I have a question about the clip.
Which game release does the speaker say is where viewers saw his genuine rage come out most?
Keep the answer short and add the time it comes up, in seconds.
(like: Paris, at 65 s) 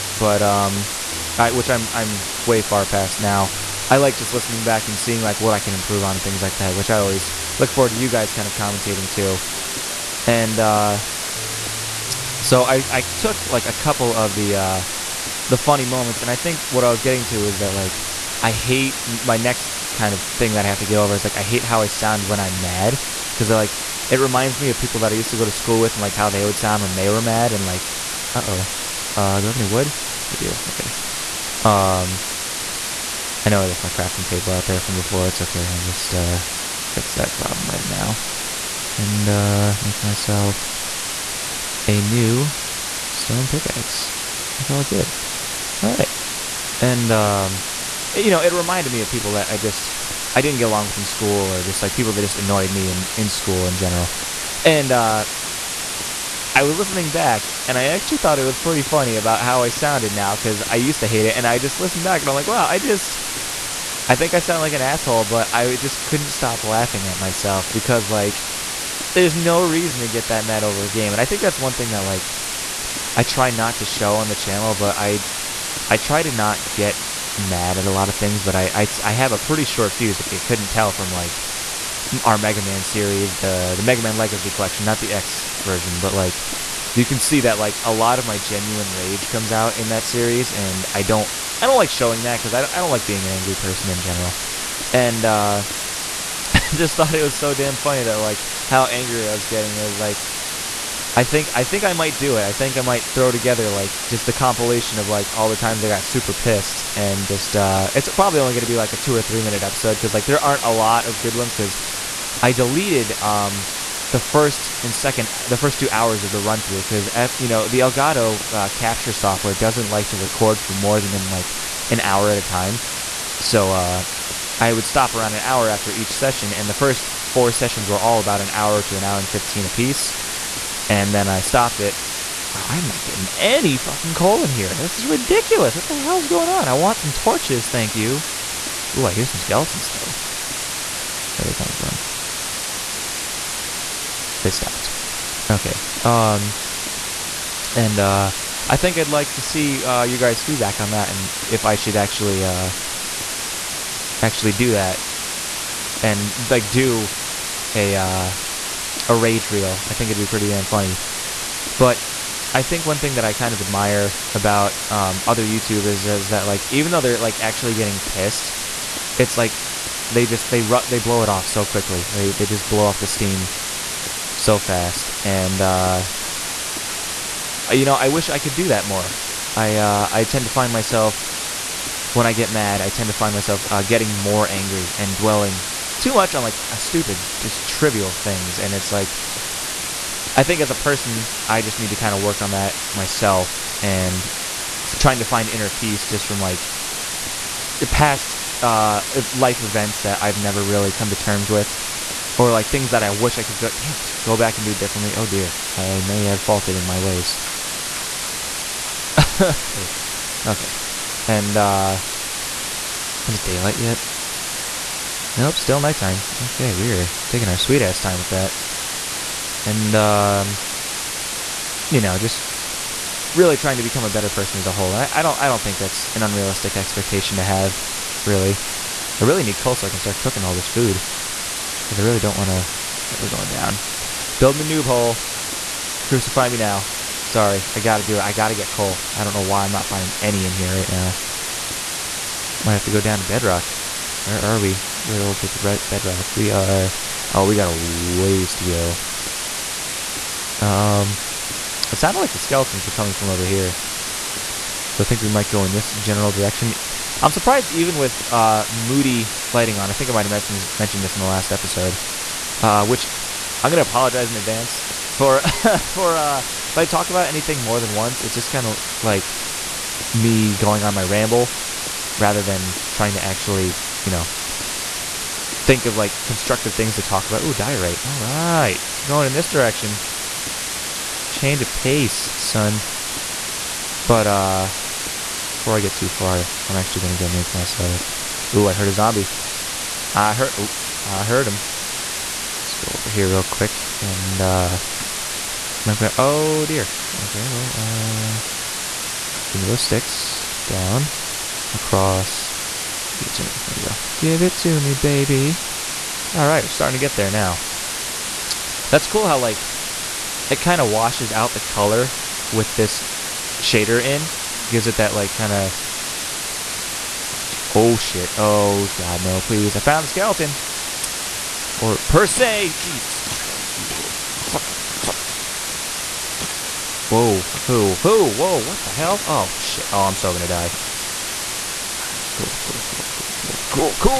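Mega Man Legacy Collection, at 83 s.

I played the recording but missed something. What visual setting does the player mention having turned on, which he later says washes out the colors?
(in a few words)
Moody lighting.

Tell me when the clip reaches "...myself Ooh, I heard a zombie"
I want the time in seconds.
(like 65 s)
287 s.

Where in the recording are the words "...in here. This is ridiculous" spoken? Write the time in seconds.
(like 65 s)
134 s.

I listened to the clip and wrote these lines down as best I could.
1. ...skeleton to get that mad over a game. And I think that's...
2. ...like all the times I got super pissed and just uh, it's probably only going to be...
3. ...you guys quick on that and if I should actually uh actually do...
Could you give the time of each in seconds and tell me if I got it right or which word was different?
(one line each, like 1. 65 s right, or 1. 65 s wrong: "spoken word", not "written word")
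1. 69 s wrong: "reason", not "skeleton"
2. 105 s right
3. 150 s wrong: "feedback", not "quick".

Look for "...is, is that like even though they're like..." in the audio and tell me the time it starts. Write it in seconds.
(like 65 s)
165 s.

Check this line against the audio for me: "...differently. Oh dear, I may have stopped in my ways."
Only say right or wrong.
wrong.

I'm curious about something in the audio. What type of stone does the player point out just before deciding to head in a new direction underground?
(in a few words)
diorite.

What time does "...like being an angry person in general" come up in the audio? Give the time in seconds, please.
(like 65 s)
92 s.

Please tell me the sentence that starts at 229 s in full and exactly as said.
I really need coal so I can start cooking all this food.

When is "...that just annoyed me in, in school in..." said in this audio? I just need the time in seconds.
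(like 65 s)
52 s.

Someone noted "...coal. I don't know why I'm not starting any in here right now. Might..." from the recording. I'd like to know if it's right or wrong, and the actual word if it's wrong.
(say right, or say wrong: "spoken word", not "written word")
wrong: "finding", not "starting".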